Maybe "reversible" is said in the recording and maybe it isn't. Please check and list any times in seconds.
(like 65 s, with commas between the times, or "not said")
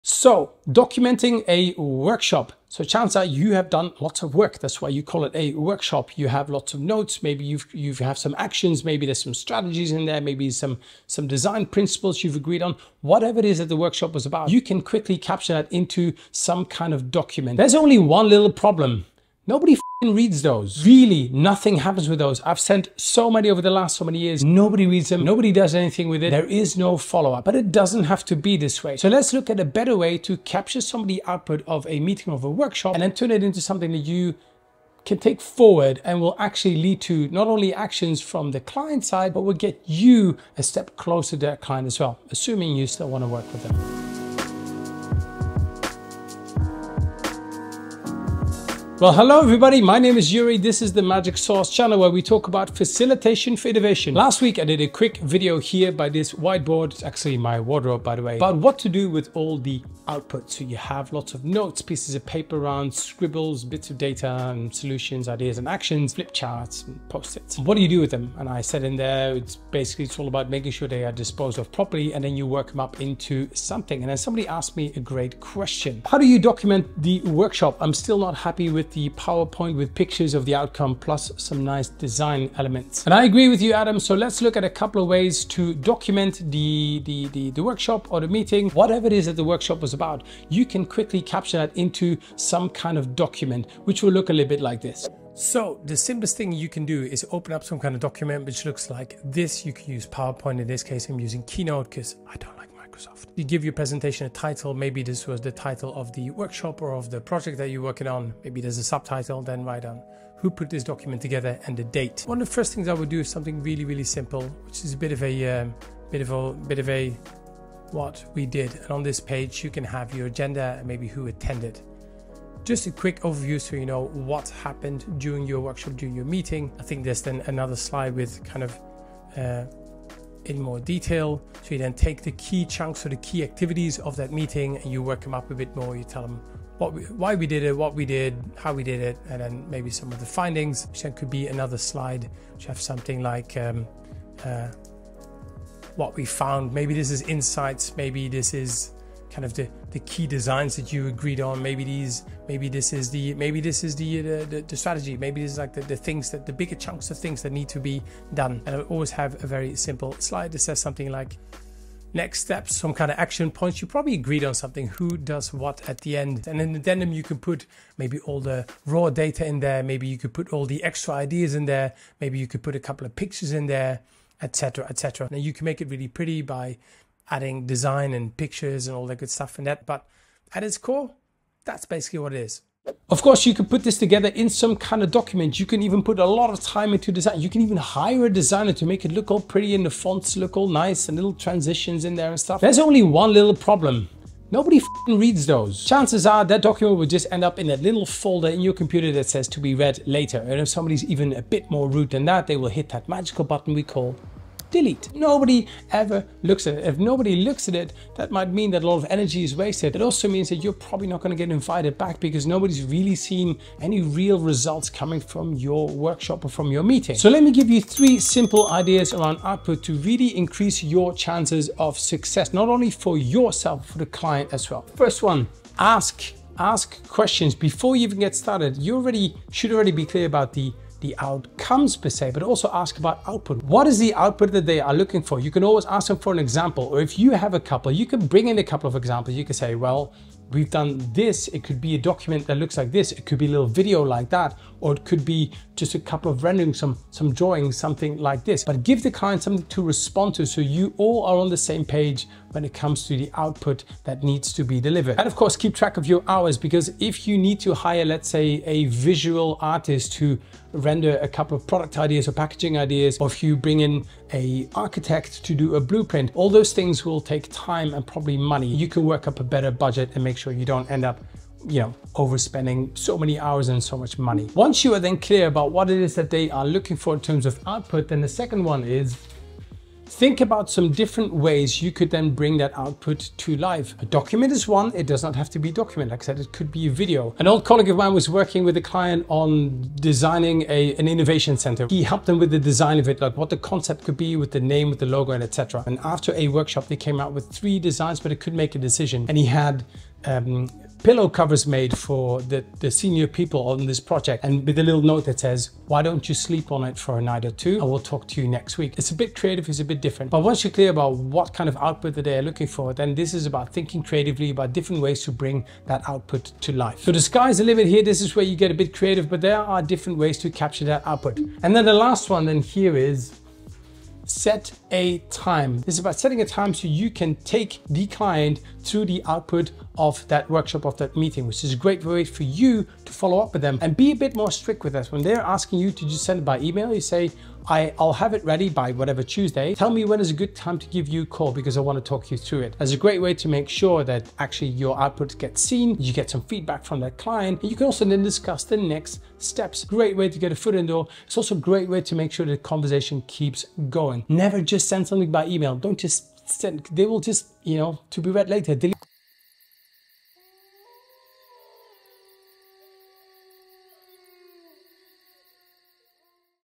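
not said.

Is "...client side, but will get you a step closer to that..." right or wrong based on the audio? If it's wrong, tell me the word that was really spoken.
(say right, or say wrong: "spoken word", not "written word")
right.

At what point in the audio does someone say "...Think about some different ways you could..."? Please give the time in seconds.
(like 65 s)
280 s.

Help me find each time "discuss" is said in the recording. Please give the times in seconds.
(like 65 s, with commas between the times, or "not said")
348 s.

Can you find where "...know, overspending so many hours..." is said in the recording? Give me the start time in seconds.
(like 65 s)
271 s.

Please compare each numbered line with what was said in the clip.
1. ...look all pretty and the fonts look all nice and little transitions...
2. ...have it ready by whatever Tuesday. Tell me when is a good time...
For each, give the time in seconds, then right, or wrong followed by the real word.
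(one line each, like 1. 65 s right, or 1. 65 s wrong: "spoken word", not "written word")
1. 189 s right
2. 338 s right.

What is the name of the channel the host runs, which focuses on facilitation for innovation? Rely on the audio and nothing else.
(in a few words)
Magic Sauce.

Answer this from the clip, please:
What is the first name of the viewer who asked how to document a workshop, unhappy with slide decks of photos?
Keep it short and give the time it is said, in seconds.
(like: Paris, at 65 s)
Adam, at 83 s.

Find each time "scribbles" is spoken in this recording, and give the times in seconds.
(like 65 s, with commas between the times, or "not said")
62 s.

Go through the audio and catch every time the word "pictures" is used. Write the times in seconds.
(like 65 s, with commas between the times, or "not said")
79 s, 173 s, 178 s.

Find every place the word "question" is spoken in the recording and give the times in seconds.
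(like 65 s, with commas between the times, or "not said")
75 s, 227 s.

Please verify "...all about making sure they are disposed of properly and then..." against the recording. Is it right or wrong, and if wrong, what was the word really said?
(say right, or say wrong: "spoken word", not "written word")
right.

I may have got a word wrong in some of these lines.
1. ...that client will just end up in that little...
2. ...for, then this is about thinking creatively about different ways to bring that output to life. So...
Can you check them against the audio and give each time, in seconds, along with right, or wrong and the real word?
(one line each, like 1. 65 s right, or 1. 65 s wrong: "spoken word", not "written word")
1. 196 s wrong: "document", not "client"
2. 312 s right.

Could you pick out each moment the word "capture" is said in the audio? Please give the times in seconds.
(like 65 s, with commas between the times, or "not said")
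15 s, 30 s, 91 s, 320 s.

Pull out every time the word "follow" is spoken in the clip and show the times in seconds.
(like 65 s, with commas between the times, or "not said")
26 s, 333 s.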